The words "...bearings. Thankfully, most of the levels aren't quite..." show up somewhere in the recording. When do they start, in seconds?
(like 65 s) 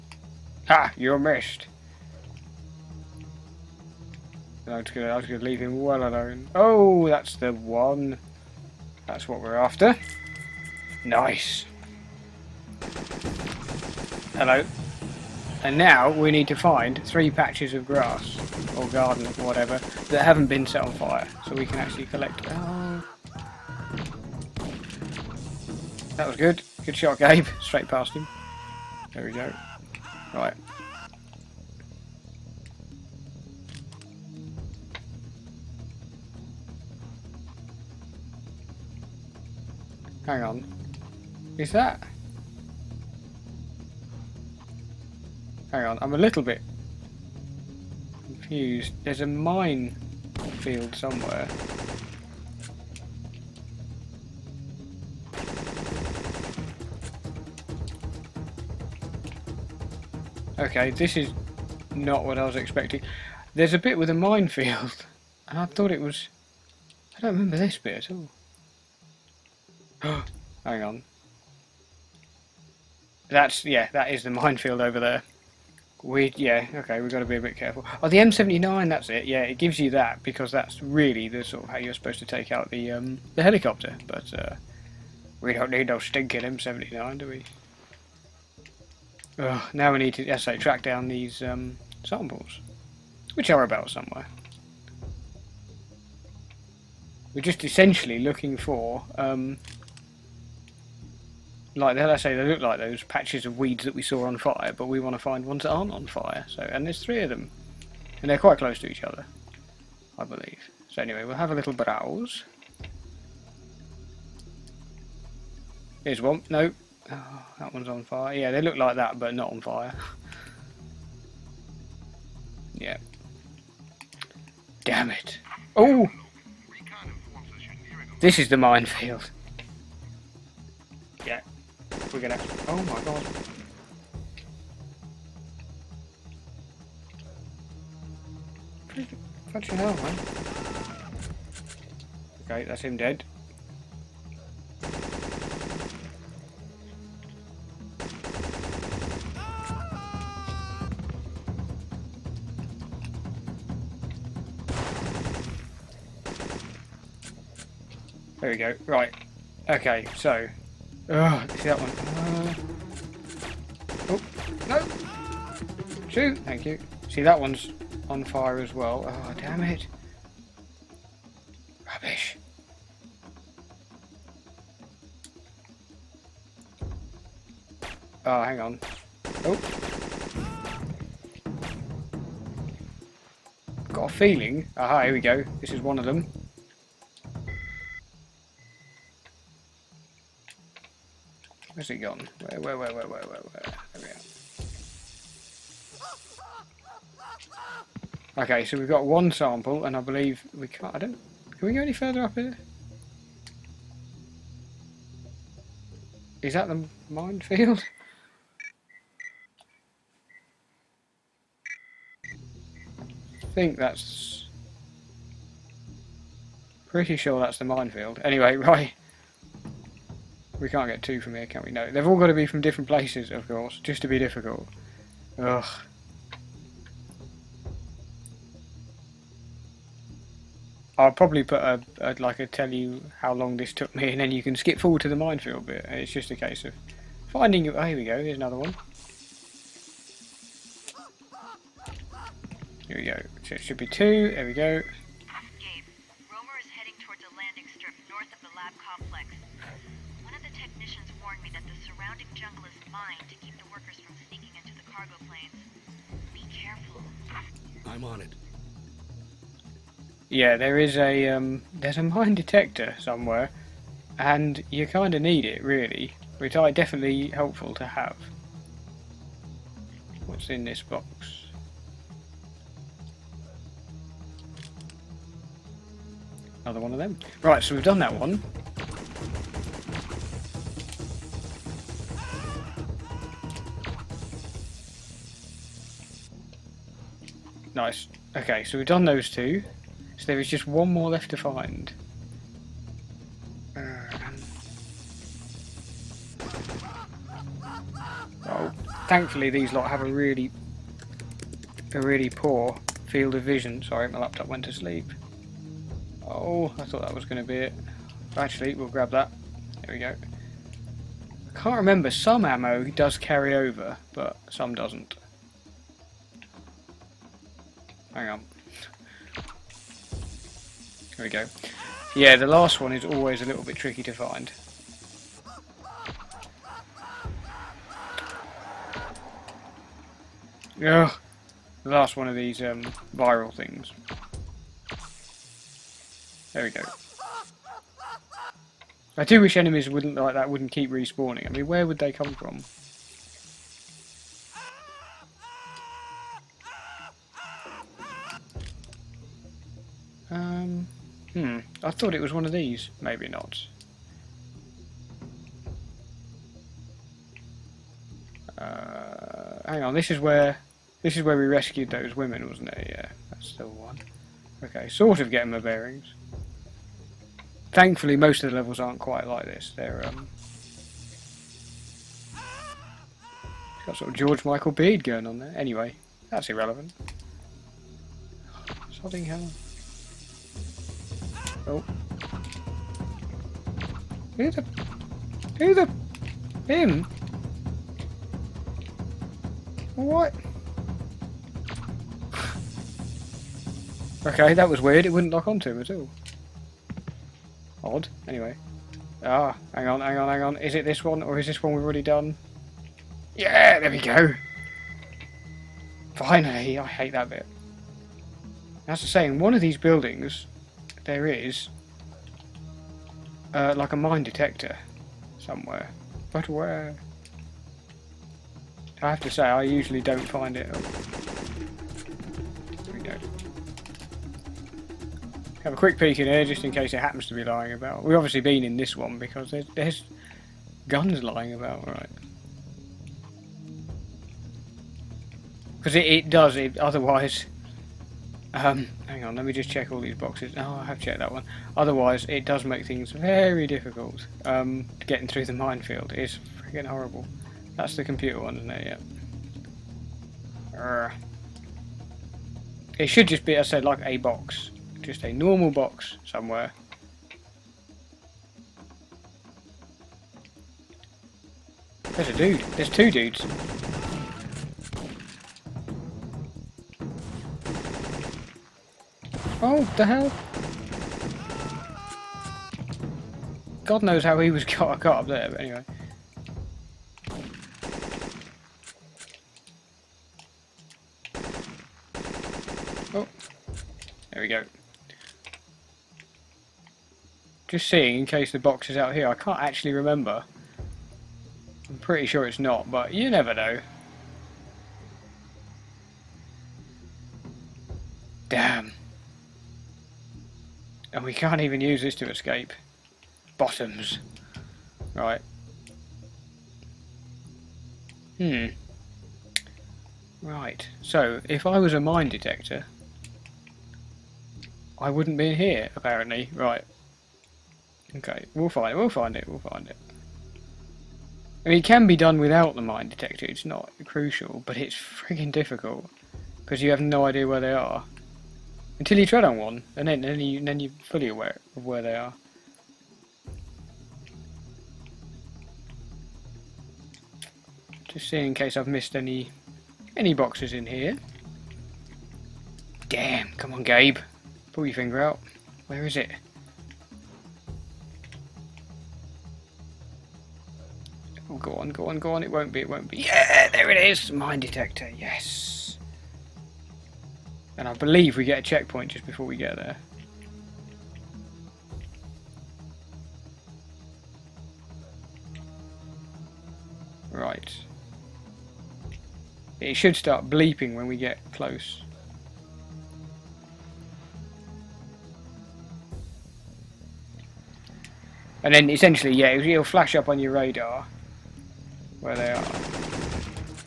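365 s.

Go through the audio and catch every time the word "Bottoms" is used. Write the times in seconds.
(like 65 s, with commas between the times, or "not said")
503 s.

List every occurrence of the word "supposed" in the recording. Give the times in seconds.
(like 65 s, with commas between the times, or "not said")
81 s.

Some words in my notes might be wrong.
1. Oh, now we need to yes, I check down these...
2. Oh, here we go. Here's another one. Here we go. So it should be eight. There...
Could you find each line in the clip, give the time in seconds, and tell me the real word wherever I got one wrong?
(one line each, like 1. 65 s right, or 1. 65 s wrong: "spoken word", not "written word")
1. 89 s wrong: "track", not "check"
2. 237 s wrong: "two", not "eight".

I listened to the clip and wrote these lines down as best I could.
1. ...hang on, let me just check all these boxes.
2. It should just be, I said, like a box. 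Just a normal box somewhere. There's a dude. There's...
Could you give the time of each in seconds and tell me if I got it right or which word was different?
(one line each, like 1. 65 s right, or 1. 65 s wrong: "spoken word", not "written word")
1. 439 s right
2. 452 s right.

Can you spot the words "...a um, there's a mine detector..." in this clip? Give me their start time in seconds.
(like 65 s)
260 s.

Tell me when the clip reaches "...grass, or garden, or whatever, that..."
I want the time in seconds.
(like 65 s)
17 s.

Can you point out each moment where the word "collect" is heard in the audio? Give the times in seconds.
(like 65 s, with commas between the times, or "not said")
22 s.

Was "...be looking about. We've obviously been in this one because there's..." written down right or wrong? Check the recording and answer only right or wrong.
wrong.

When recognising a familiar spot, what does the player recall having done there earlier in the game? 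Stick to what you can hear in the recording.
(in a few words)
rescued those women.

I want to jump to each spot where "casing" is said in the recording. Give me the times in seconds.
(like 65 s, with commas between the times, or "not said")
not said.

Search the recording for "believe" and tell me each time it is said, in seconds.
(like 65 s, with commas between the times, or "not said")
110 s, 200 s, 557 s.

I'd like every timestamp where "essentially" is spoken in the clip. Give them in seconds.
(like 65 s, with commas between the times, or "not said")
97 s, 578 s.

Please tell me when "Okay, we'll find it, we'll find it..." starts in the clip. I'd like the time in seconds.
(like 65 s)
518 s.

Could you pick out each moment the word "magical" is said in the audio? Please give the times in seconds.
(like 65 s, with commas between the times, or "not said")
not said.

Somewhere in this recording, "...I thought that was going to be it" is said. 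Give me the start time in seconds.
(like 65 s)
306 s.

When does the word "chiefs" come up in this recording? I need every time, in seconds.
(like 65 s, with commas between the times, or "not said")
not said.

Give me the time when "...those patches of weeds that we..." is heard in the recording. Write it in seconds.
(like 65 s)
102 s.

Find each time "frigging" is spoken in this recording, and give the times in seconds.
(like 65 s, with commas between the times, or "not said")
524 s.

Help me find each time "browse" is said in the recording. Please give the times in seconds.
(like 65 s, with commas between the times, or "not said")
111 s.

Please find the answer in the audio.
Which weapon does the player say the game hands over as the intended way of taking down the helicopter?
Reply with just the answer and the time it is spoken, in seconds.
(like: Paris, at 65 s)
M79, at 78 s.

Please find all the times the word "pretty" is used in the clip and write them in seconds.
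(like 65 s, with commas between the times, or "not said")
216 s, 491 s.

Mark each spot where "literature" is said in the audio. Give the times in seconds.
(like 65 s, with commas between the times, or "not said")
not said.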